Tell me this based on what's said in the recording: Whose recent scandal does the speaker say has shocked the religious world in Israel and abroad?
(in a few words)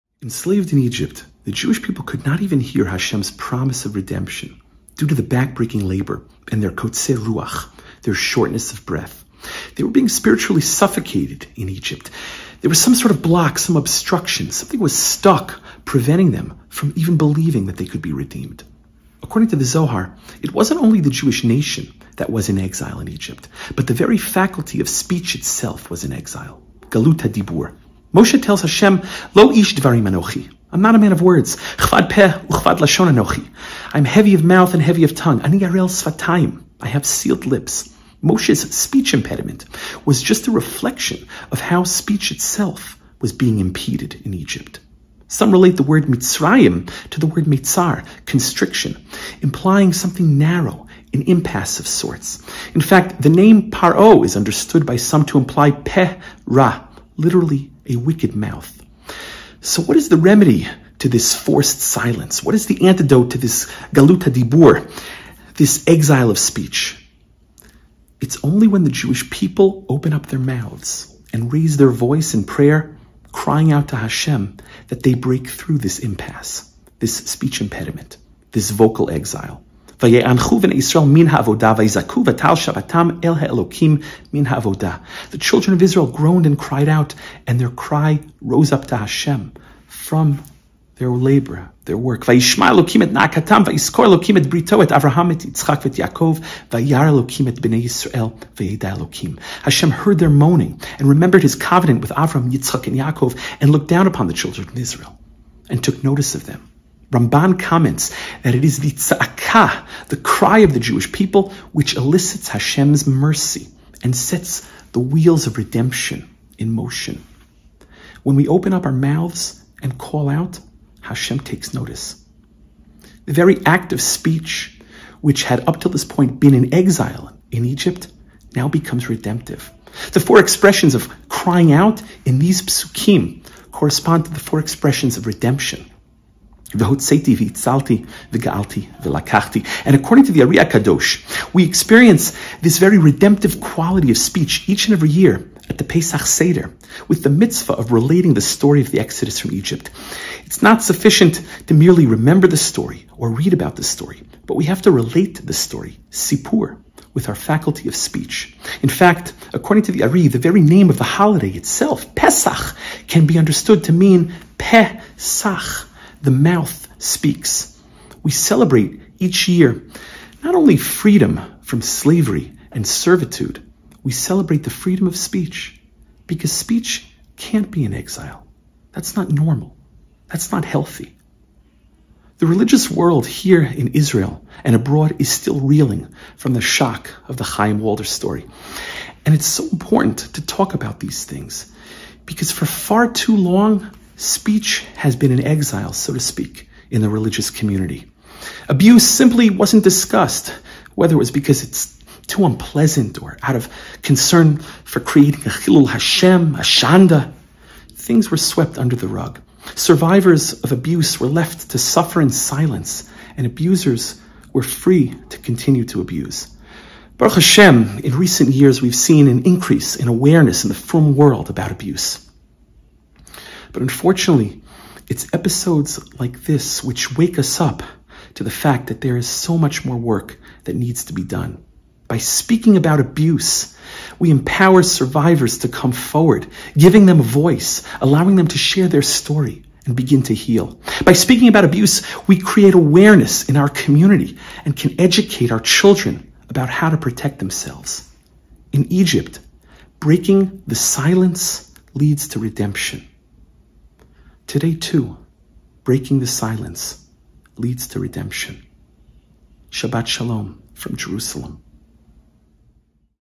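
Chaim Walder.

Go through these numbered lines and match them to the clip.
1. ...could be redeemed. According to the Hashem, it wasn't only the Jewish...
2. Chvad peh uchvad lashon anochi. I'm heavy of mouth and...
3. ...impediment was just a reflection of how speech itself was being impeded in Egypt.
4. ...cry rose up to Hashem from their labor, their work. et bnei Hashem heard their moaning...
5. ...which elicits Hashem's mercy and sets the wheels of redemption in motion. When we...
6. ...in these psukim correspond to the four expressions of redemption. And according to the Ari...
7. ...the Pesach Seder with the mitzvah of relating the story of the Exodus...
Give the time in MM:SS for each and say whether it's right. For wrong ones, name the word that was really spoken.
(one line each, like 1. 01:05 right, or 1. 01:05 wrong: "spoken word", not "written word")
1. 00:17 wrong: "Zohar", not "Hashem"
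2. 00:31 right
3. 00:39 right
4. 01:27 right
5. 01:51 right
6. 02:12 right
7. 02:25 right.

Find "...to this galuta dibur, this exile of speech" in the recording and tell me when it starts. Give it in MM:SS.
01:03.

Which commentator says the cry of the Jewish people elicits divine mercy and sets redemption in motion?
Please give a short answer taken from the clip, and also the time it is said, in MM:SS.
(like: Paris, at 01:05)
Ramban, at 01:47.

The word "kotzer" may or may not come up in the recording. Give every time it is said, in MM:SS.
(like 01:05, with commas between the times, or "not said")
00:06.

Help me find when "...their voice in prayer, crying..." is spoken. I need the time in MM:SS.
01:11.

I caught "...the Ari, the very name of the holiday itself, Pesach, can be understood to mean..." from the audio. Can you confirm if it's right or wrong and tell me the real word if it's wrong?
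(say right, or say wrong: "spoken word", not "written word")
right.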